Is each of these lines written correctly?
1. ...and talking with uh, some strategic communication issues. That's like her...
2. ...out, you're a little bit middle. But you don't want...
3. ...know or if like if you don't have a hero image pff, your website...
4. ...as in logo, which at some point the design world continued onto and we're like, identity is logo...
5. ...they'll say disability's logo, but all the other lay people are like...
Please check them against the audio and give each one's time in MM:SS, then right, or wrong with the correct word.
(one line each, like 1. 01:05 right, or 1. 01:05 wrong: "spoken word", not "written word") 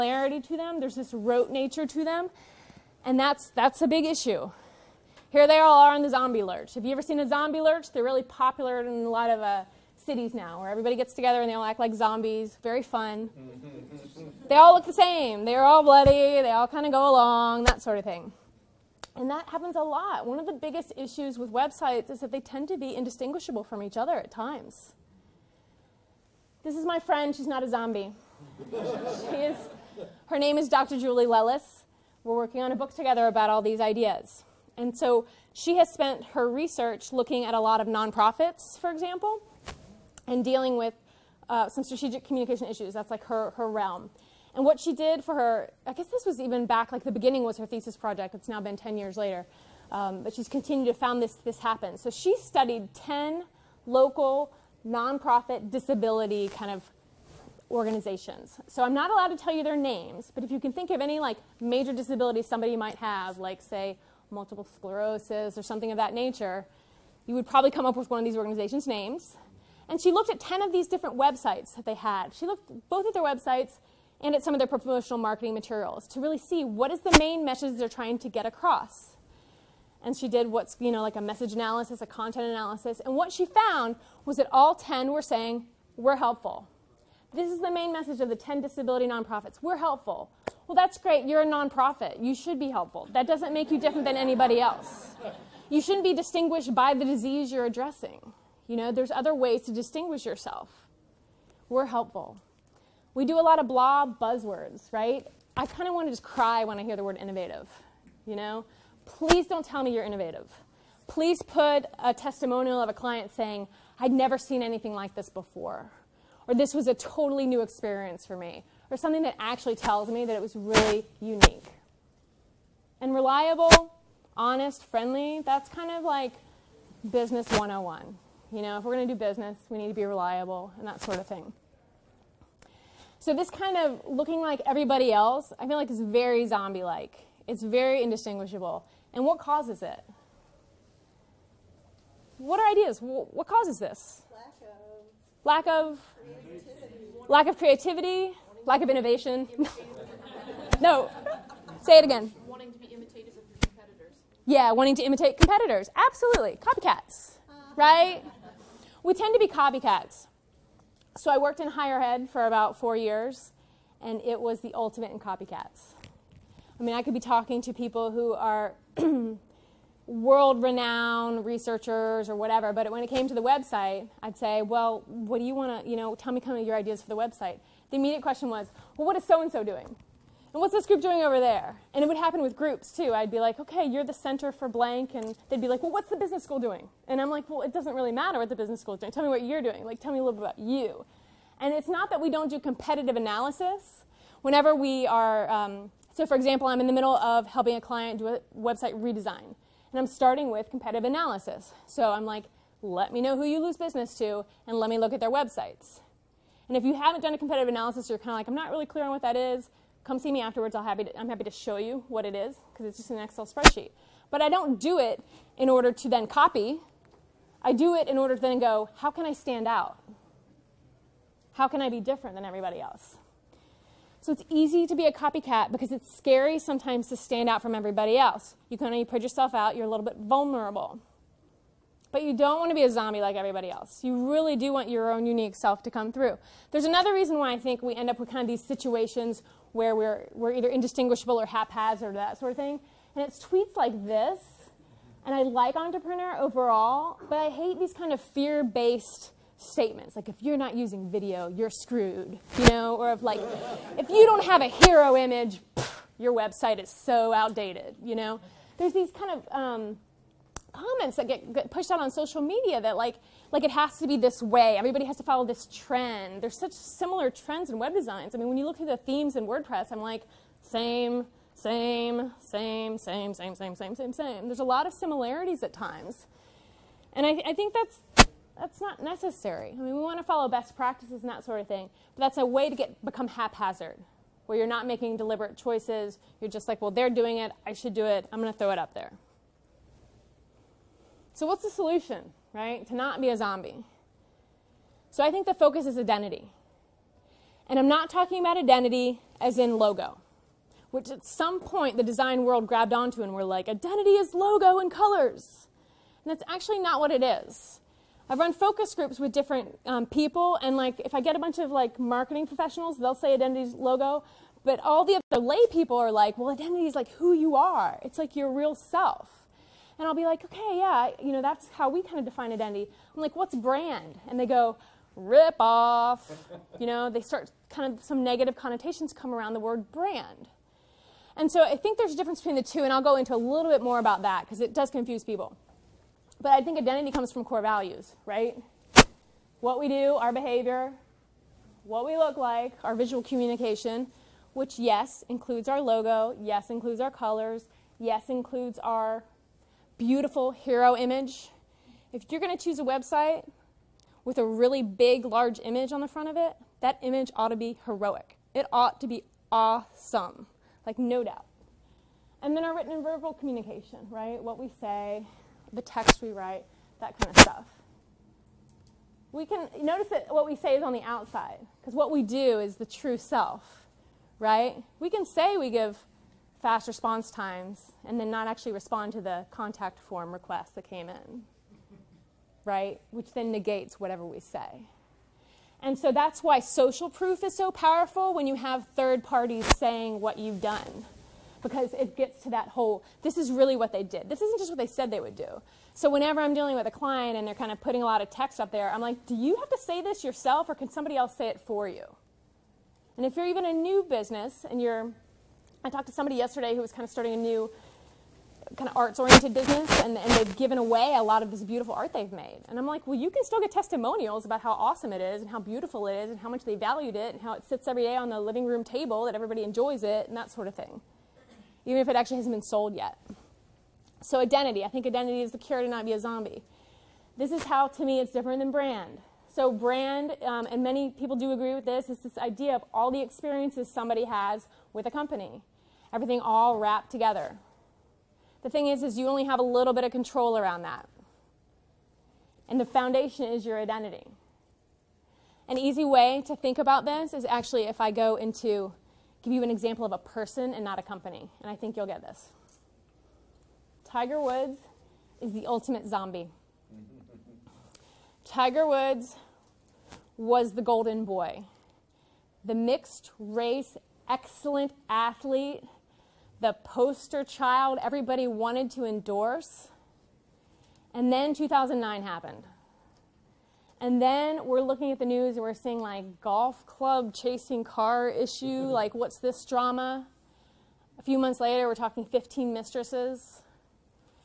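1. 00:40 wrong: "dealing", not "talking"
2. 03:49 wrong: "vulnerable", not "middle"
3. 04:12 right
4. 04:59 wrong: "grabbed", not "continued"
5. 05:12 wrong: "identity", not "disability".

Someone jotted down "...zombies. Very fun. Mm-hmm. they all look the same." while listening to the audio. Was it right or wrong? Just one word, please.
right.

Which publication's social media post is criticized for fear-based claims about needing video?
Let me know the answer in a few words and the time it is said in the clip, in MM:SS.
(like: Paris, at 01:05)
Entrepreneur, at 04:05.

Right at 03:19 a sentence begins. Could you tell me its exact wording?
And I'm starting with competitive analysis.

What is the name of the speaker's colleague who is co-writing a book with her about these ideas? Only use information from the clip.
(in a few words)
Dr. Julie Lellis.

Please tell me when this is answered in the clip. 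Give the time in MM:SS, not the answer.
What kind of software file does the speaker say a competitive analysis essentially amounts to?
03:33.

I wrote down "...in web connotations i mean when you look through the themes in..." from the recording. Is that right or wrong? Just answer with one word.
wrong.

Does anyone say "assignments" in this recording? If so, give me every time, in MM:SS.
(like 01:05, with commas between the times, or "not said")
not said.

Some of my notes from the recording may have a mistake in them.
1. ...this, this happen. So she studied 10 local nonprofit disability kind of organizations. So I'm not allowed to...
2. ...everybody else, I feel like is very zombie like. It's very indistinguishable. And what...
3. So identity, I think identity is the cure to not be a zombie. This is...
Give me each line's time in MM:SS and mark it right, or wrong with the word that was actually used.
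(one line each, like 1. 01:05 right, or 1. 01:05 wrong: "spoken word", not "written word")
1. 00:51 right
2. 02:14 right
3. 07:04 right.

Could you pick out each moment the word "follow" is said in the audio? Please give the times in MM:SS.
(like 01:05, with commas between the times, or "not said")
04:25, 04:40.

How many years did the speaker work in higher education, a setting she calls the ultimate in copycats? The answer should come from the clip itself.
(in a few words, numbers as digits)
4.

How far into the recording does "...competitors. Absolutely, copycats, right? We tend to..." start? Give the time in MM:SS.
02:35.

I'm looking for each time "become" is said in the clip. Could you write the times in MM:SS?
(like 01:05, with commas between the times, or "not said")
04:43.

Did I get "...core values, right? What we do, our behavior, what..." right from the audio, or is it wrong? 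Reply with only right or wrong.
right.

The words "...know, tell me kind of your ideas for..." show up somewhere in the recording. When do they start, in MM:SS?
02:55.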